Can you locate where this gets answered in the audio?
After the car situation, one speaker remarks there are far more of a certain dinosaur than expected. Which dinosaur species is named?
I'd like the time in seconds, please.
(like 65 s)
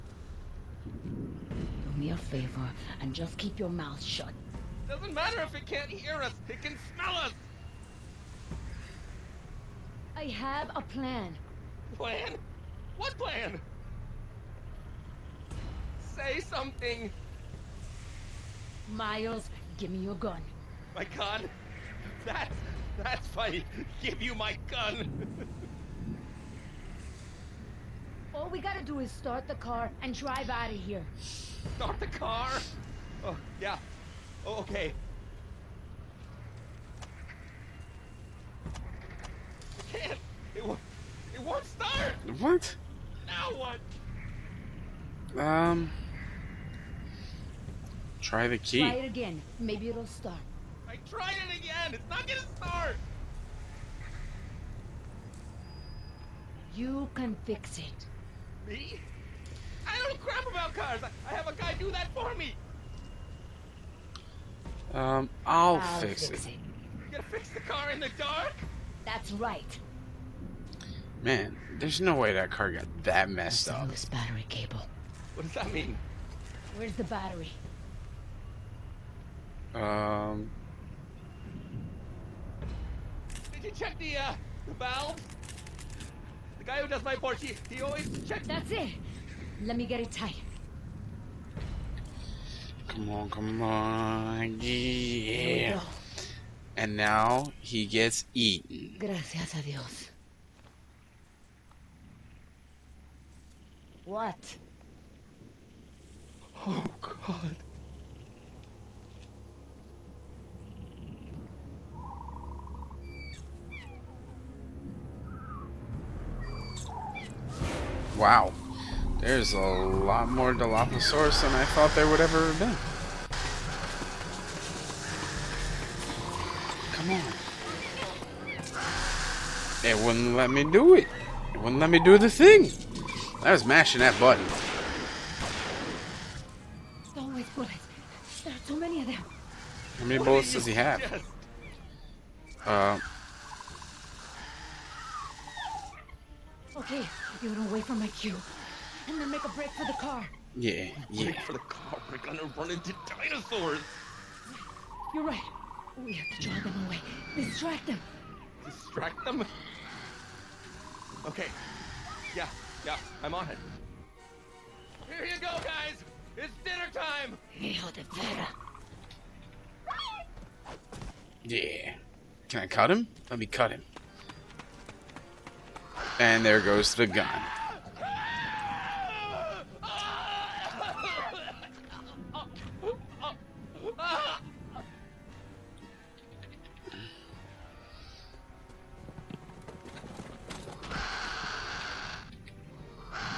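120 s.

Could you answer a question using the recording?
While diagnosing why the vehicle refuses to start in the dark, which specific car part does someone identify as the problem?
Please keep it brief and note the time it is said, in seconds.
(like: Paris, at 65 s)
Battery cable, at 74 s.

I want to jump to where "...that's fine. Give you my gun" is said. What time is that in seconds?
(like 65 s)
23 s.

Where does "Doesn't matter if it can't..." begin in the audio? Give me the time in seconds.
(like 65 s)
4 s.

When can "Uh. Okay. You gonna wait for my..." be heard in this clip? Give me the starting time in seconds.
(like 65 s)
142 s.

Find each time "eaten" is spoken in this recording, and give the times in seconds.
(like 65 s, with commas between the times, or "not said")
98 s.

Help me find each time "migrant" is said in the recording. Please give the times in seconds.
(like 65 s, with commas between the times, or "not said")
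not said.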